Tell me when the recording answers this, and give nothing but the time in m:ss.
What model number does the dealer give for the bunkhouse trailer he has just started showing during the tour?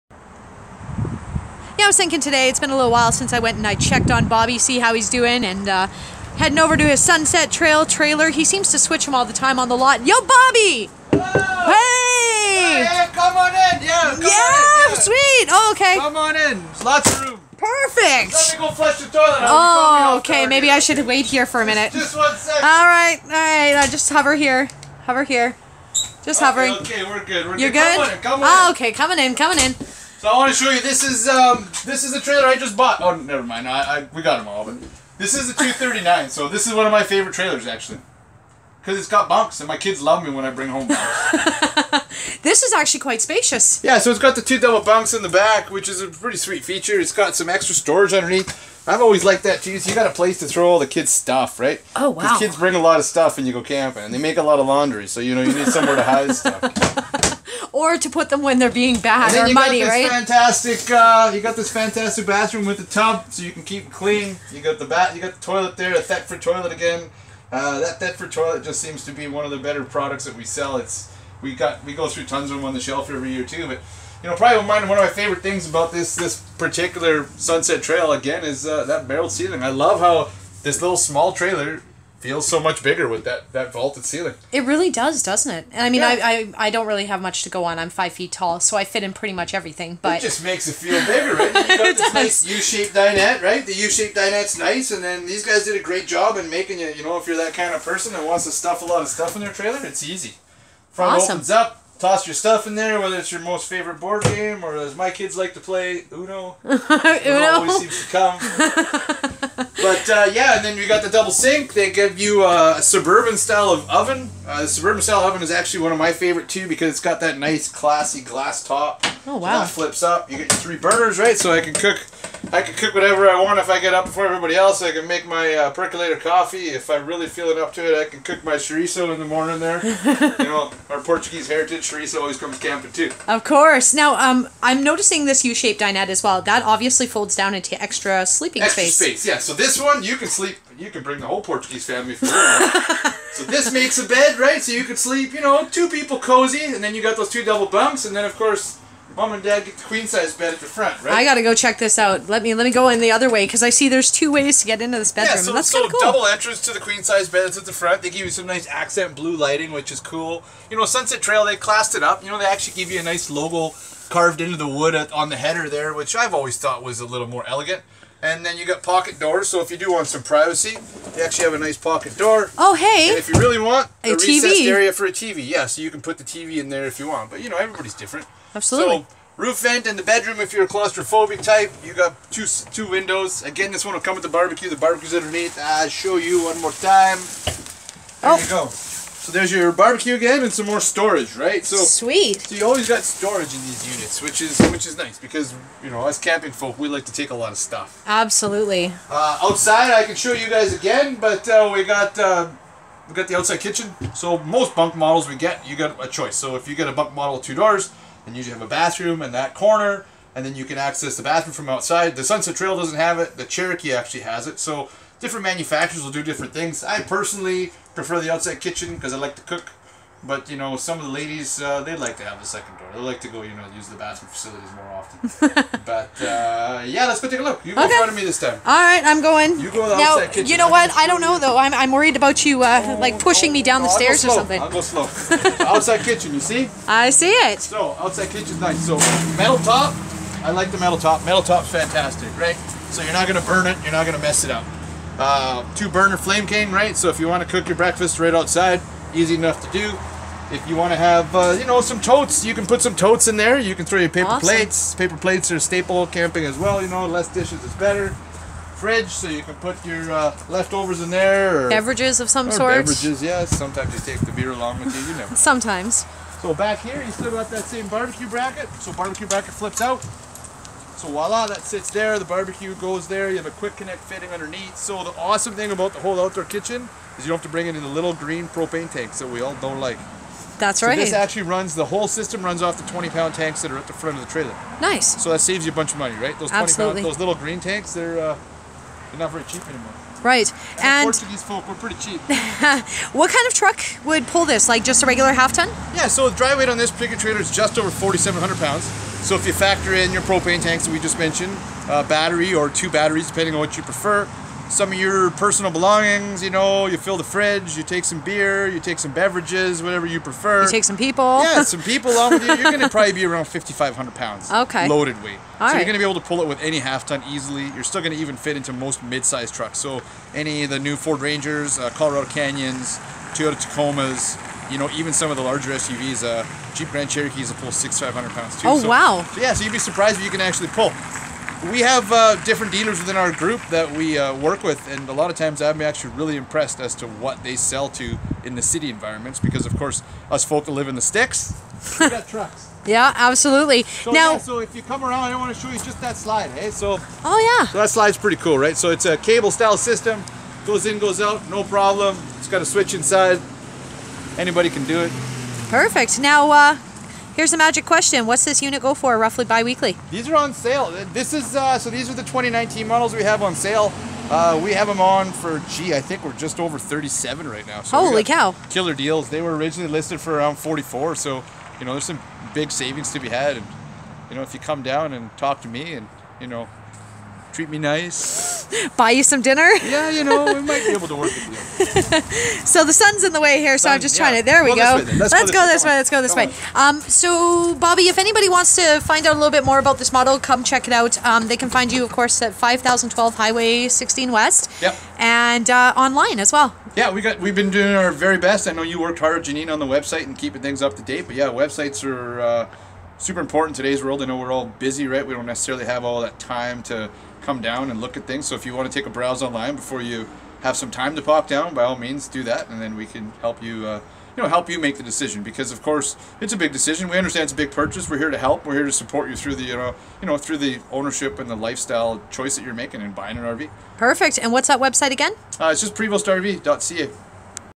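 0:35.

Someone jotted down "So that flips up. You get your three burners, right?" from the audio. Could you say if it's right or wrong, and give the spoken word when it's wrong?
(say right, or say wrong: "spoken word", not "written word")
right.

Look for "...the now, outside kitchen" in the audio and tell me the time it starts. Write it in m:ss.
3:49.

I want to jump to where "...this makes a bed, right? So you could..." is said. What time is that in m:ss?
2:23.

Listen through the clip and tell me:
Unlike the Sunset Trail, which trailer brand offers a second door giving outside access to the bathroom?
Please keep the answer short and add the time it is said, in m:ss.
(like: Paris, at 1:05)
Cherokee, at 3:33.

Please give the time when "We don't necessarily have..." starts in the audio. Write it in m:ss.
6:45.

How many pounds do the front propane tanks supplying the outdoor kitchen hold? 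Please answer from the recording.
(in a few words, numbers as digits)
20.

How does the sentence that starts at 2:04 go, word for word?
I can make my uh, percolator coffee if I really feel it up to it.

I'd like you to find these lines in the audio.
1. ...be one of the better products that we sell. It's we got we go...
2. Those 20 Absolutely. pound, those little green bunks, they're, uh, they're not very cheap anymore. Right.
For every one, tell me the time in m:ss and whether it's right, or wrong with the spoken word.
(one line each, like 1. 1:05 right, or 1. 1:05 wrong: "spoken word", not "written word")
1. 1:09 right
2. 4:46 wrong: "tanks", not "bunks".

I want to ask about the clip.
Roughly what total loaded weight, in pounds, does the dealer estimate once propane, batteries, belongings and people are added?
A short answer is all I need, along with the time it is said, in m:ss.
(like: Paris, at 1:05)
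5,500, at 5:13.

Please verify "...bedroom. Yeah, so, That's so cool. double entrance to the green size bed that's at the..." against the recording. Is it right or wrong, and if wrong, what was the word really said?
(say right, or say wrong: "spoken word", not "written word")
wrong: "queen", not "green".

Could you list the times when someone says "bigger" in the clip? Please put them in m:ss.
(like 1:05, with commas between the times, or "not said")
1:22, 1:31.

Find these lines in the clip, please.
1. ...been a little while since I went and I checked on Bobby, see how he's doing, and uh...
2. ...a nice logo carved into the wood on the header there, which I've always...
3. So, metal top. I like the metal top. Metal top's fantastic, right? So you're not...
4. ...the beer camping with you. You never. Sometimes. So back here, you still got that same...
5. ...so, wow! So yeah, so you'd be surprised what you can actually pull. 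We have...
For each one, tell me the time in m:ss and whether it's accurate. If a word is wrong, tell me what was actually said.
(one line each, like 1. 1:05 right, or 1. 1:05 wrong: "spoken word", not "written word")
1. 0:02 right
2. 2:42 right
3. 3:58 right
4. 4:24 wrong: "along", not "camping"
5. 5:28 right.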